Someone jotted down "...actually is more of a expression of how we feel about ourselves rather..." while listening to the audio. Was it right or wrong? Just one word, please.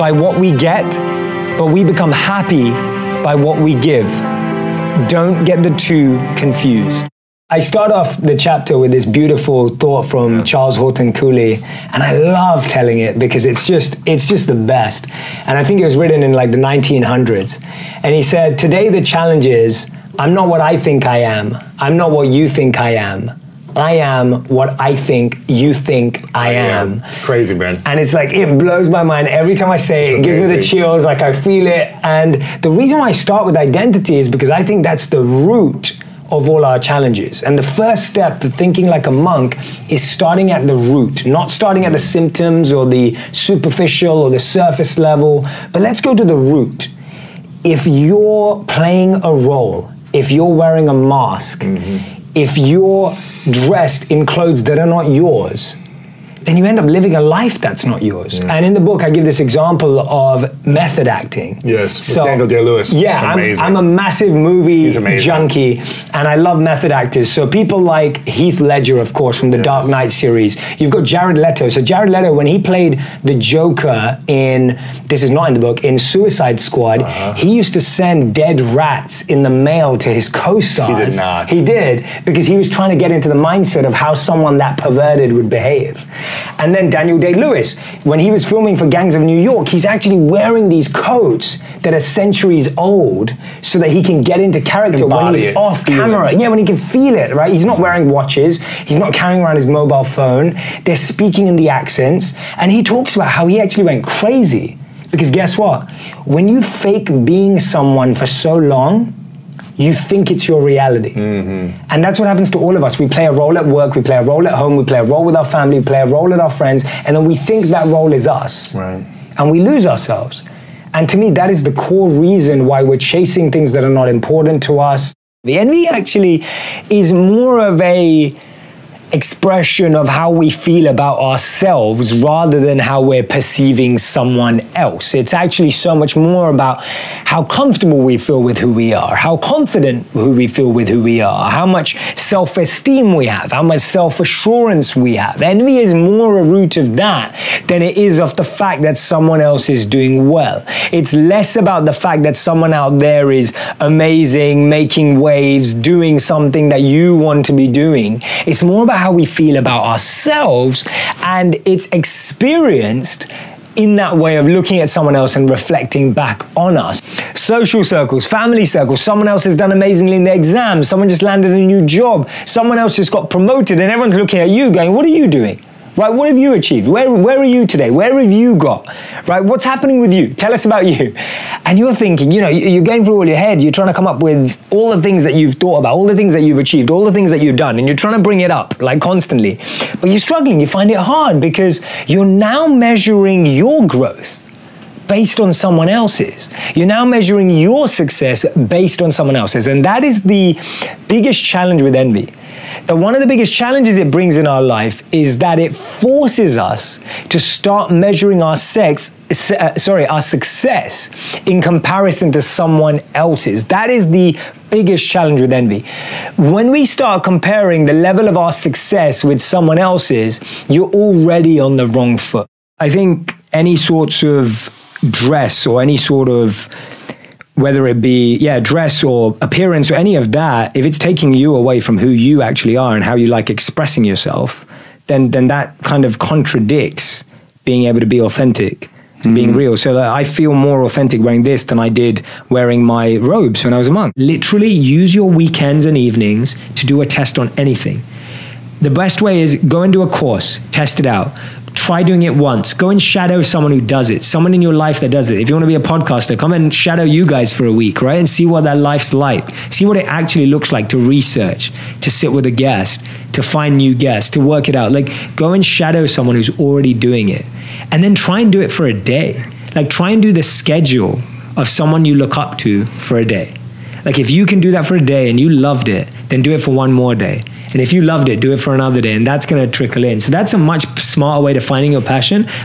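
right.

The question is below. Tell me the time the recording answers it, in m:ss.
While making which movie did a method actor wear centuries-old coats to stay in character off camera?
1:28.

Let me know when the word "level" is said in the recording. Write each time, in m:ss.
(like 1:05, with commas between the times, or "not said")
0:44, 3:37.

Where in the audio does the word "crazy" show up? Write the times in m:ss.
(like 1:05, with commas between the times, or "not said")
0:27, 1:44.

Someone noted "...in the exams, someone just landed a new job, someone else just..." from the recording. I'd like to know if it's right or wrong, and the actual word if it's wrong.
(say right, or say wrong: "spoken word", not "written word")
right.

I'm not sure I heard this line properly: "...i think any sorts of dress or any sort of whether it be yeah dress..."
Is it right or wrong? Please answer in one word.
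right.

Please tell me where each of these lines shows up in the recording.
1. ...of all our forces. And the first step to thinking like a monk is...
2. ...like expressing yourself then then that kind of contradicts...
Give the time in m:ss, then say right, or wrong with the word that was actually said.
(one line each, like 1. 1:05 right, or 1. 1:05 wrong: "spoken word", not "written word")
1. 0:36 wrong: "challenges", not "forces"
2. 3:53 right.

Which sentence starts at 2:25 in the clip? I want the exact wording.
Envy is more a root of that than it is of the fact that someone else is doing well.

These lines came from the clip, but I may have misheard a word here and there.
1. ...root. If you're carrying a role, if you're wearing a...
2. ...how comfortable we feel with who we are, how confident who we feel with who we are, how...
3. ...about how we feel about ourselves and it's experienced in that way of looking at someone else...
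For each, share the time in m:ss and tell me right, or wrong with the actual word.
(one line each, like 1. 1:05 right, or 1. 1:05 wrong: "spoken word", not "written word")
1. 0:46 wrong: "playing", not "carrying"
2. 2:16 right
3. 2:38 right.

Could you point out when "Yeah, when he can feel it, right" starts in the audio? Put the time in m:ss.
1:36.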